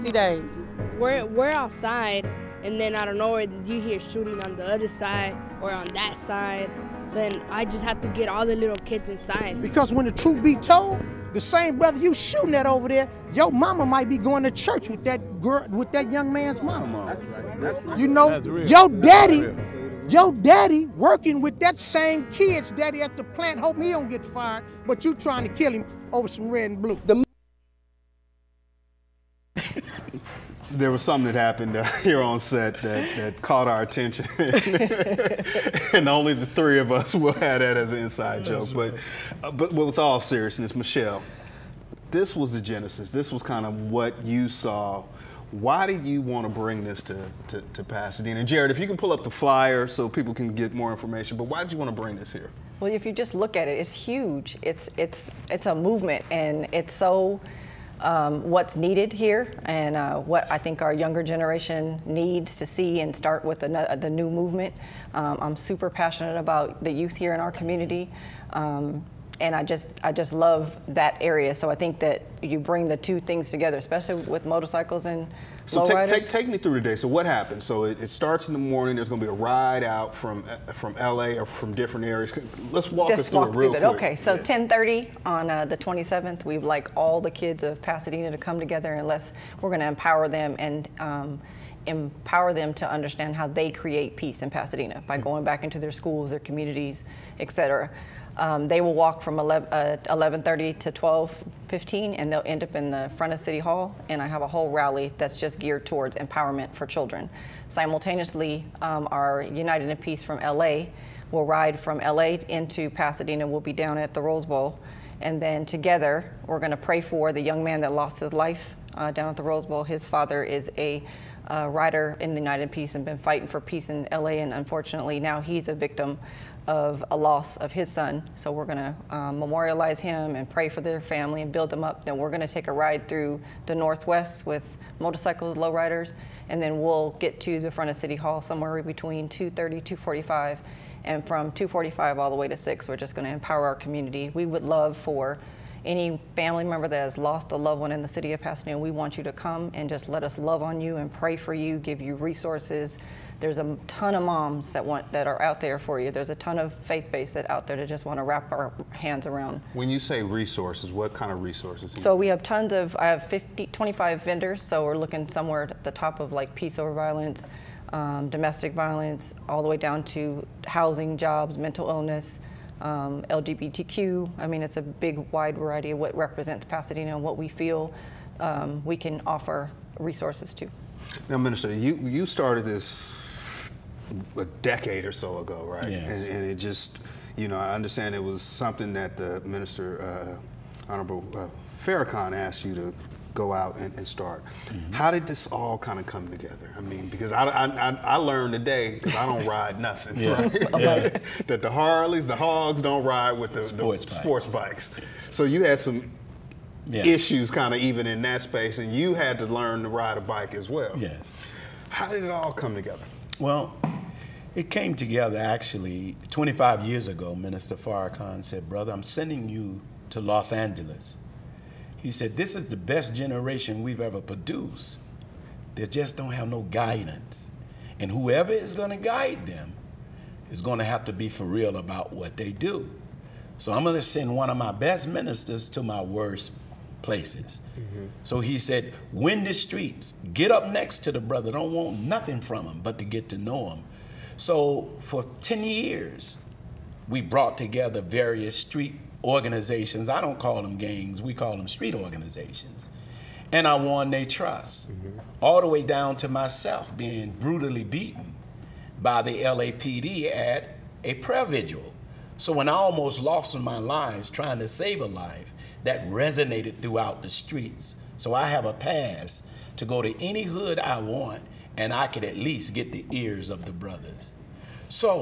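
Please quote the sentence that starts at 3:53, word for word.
So I'm going to send one of my best ministers to my worst places.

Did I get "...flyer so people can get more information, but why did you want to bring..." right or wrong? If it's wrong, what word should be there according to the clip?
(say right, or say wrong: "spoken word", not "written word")
right.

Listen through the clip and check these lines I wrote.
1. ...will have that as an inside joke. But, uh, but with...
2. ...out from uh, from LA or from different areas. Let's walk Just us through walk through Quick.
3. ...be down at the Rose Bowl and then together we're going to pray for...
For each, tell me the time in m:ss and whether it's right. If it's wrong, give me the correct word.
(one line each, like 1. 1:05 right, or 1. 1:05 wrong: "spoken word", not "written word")
1. 0:37 right
2. 1:19 right
3. 1:53 right.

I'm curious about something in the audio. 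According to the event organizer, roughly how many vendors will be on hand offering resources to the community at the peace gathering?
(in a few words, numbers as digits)
25.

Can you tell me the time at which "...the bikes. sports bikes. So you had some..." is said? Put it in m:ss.
3:24.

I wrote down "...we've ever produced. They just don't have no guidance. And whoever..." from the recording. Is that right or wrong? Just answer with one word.
right.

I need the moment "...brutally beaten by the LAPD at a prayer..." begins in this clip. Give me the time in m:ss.
4:17.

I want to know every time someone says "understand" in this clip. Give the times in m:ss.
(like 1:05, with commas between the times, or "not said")
1:32, 3:07.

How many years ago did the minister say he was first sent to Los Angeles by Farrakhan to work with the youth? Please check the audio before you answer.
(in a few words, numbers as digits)
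25.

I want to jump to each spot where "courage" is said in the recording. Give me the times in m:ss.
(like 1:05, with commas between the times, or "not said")
not said.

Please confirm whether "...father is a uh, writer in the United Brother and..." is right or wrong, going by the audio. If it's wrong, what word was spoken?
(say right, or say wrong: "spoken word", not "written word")
wrong: "Peace", not "Brother".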